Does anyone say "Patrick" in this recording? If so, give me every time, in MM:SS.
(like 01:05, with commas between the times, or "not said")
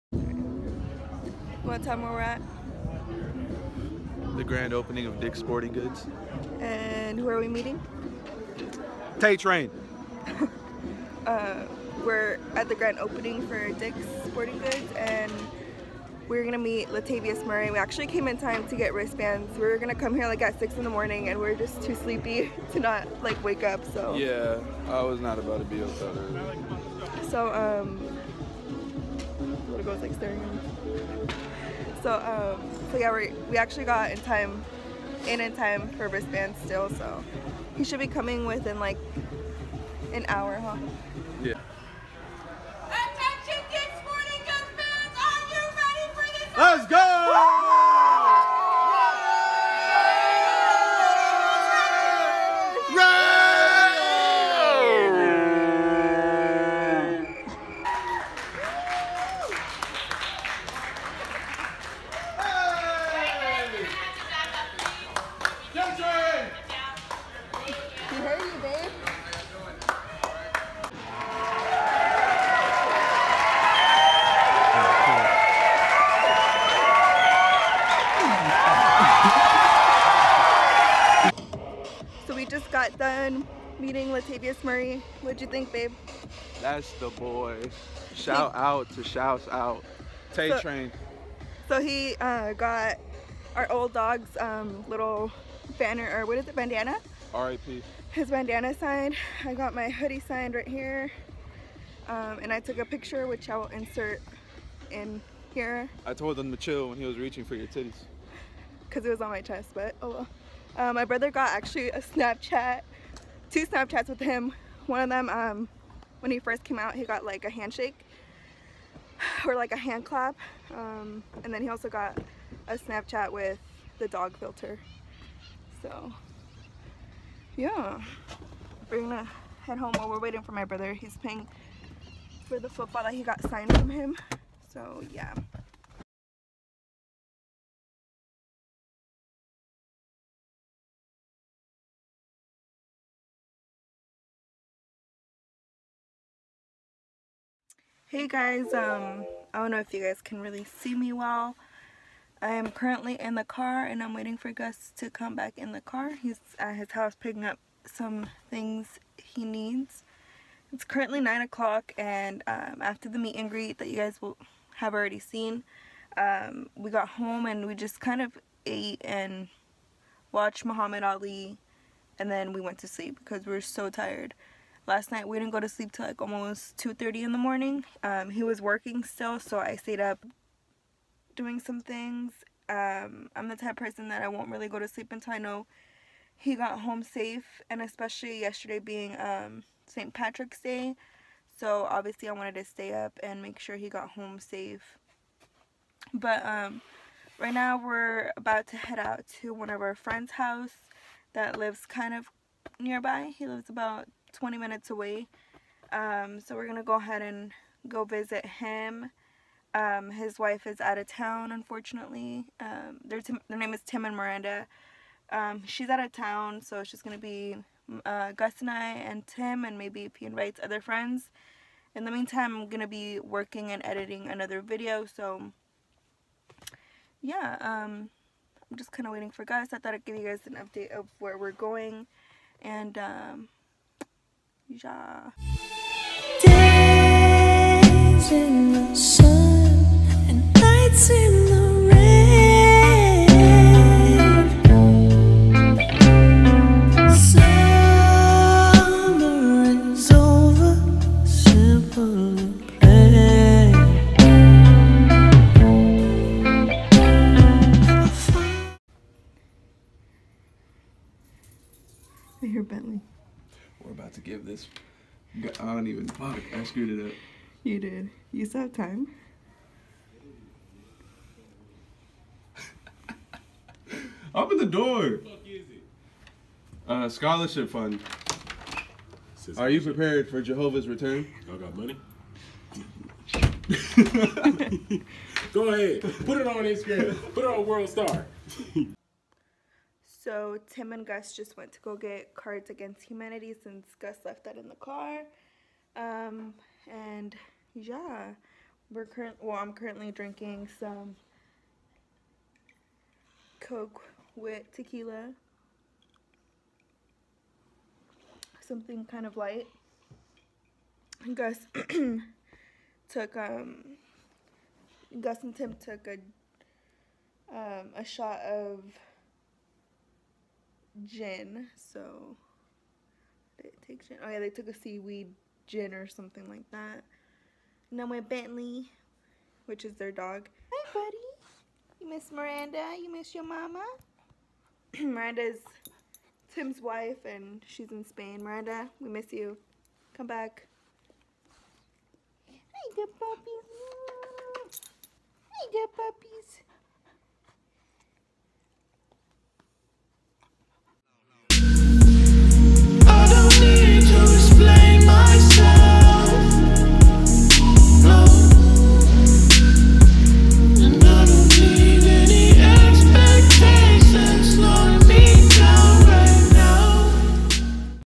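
03:10.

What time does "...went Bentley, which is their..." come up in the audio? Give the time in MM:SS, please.
05:28.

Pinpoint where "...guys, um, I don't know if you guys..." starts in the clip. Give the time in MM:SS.
02:28.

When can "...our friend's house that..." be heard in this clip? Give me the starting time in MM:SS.
03:19.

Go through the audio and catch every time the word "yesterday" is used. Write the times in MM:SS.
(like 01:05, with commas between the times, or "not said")
03:08.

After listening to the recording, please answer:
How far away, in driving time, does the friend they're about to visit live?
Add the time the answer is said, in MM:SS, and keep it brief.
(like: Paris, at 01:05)
20 minutes, at 03:24.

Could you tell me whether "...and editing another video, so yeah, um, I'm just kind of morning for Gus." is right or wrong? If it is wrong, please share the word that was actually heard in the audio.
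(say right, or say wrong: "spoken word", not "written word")
wrong: "waiting", not "morning".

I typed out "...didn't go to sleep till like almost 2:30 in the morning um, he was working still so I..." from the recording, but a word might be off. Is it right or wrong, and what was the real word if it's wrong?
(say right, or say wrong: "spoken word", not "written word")
right.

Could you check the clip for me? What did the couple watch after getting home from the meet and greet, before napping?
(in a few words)
Muhammad Ali.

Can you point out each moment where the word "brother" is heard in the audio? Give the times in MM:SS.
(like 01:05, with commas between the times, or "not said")
01:51, 02:10.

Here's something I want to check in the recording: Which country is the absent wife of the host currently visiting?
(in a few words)
Spain.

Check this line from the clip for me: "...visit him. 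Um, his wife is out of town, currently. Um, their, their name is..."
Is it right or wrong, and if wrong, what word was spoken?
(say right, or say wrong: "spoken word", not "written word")
wrong: "unfortunately", not "currently".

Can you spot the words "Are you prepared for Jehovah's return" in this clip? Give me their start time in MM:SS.
04:39.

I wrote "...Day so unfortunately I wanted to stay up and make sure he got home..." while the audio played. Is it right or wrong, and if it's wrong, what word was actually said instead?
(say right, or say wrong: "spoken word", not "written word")
wrong: "obviously", not "unfortunately".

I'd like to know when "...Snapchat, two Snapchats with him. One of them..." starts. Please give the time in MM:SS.
01:52.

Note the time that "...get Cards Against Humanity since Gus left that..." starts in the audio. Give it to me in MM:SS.
04:51.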